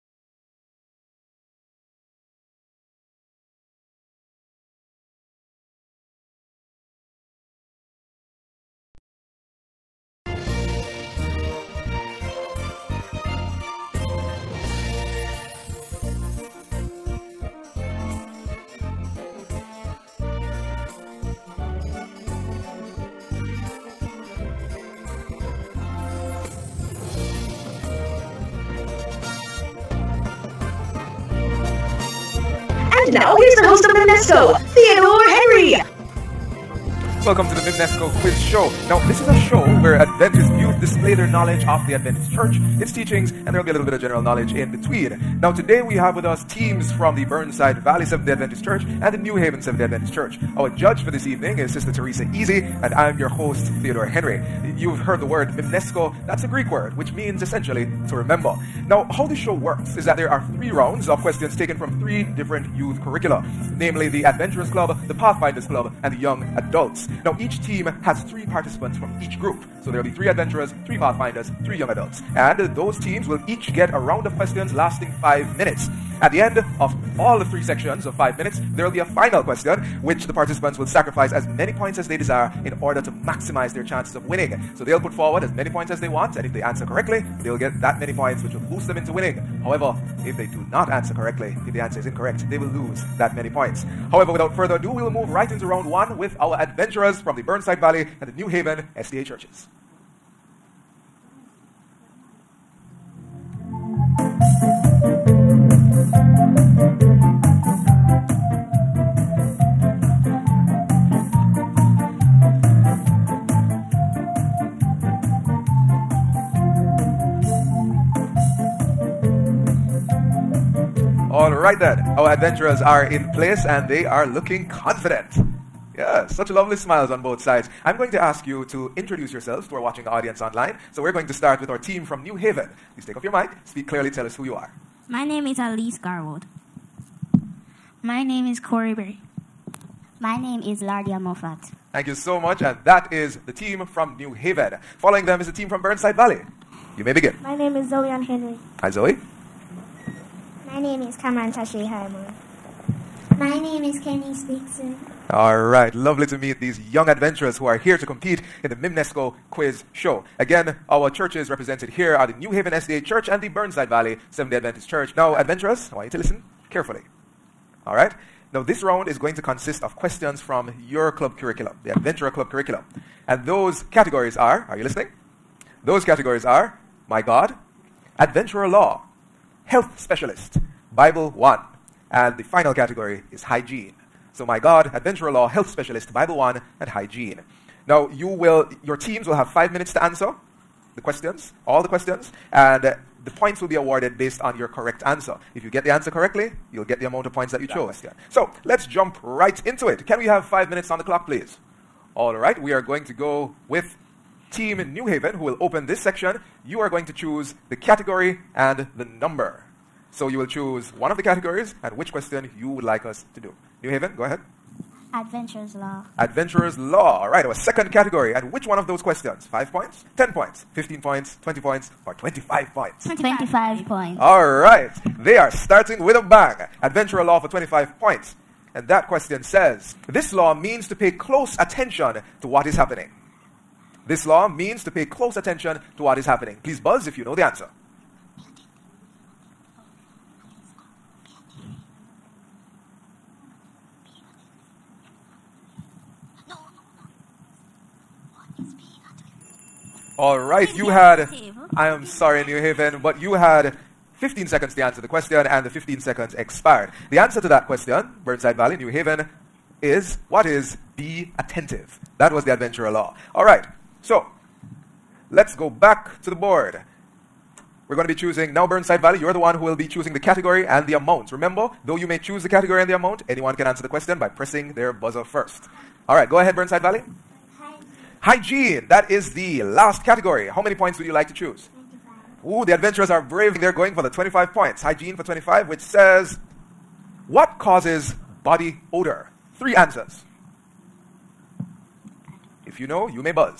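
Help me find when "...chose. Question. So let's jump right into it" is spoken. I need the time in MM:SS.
03:17.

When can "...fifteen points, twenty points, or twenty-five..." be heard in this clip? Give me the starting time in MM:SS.
03:40.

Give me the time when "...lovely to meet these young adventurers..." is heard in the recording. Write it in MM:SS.
02:35.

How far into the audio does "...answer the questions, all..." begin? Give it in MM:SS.
03:10.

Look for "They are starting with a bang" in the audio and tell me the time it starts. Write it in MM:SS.
03:45.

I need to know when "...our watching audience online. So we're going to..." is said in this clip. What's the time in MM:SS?
02:09.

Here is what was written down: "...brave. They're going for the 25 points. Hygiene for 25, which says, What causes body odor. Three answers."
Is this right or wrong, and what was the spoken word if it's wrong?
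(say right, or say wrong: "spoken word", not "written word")
right.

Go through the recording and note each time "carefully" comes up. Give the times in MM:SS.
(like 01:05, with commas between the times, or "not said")
02:46.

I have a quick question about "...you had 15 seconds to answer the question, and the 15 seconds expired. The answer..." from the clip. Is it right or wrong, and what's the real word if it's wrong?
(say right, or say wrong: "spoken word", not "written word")
right.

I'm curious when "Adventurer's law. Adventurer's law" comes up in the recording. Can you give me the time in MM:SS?
03:35.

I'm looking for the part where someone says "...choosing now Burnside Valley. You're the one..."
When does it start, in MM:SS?
04:28.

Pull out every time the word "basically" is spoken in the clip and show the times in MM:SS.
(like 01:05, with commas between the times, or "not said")
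not said.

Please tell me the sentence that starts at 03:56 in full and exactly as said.
Please buzz if you know the answer.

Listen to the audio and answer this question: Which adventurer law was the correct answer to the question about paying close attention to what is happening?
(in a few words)
Be attentive.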